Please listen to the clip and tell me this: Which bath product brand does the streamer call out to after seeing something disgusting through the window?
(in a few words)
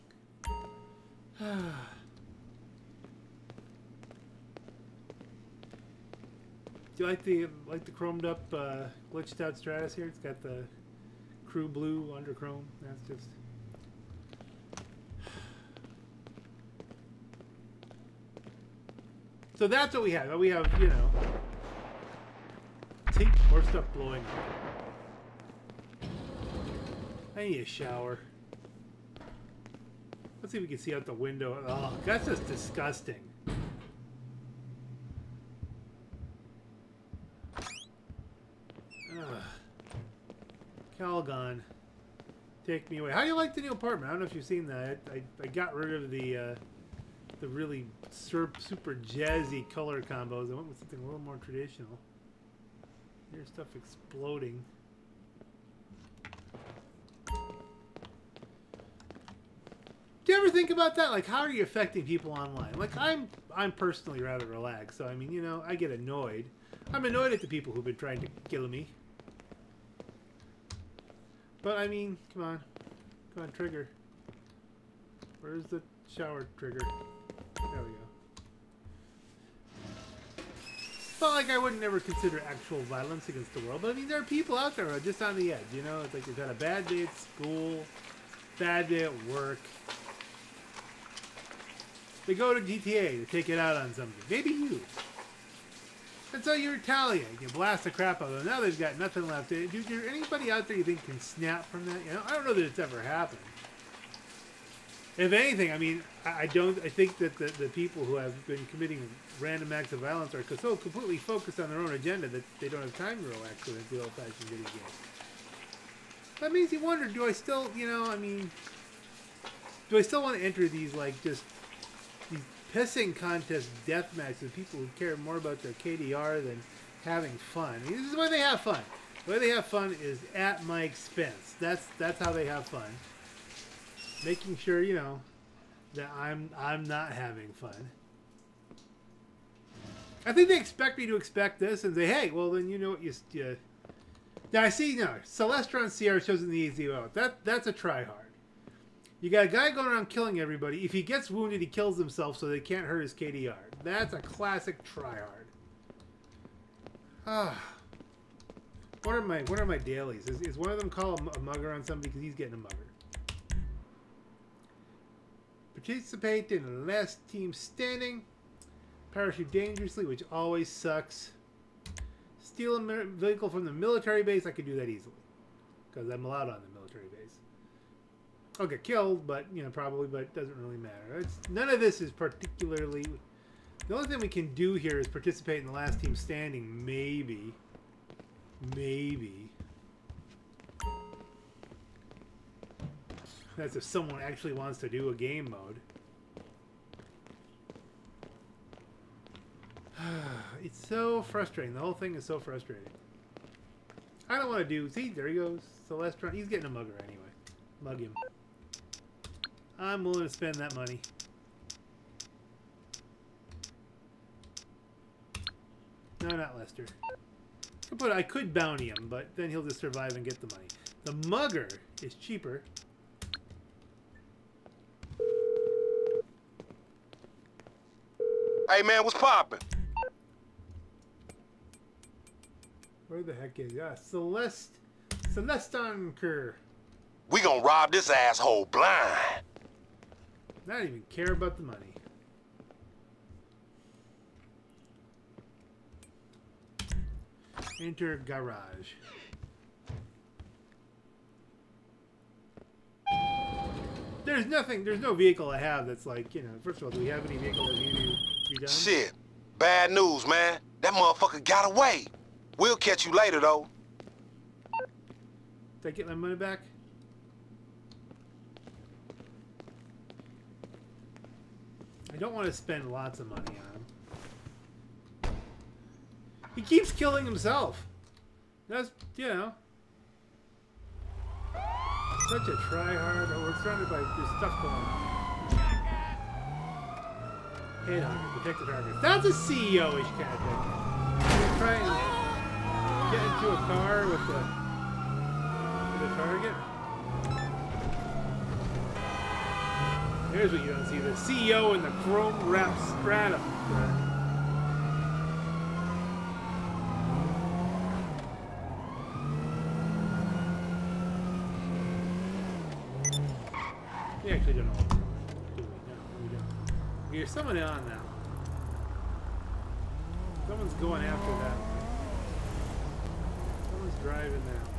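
Calgon.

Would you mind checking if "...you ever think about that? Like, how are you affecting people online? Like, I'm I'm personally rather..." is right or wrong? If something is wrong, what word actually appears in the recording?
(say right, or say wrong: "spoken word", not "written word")
right.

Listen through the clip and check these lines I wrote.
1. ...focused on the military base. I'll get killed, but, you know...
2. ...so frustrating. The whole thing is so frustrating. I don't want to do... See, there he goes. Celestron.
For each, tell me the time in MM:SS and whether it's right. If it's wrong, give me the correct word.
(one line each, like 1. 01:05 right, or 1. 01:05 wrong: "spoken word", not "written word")
1. 02:56 wrong: "allowed", not "focused"
2. 03:20 right.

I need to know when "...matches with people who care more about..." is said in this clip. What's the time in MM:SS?
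02:04.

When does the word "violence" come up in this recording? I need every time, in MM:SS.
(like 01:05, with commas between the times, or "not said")
01:22, 01:49.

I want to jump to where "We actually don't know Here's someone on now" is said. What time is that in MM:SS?
05:14.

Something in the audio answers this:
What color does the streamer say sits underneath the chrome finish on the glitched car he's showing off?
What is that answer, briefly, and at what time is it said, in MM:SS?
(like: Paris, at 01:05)
Crew blue, at 00:11.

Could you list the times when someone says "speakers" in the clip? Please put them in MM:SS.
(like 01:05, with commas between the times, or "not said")
not said.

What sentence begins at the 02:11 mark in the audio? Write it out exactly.
That's that's how they have fun making sure you know that I'm I'm not having fun.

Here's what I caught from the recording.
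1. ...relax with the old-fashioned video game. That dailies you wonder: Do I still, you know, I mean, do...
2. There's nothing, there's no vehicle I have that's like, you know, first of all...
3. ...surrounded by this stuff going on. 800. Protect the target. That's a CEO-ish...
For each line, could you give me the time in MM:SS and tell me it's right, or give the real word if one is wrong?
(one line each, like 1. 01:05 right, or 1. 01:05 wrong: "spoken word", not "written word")
1. 01:53 wrong: "makes", not "dailies"
2. 04:14 right
3. 04:43 right.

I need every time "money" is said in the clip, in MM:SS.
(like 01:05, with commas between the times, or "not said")
03:30, 03:40, 04:01, 04:26, 04:33.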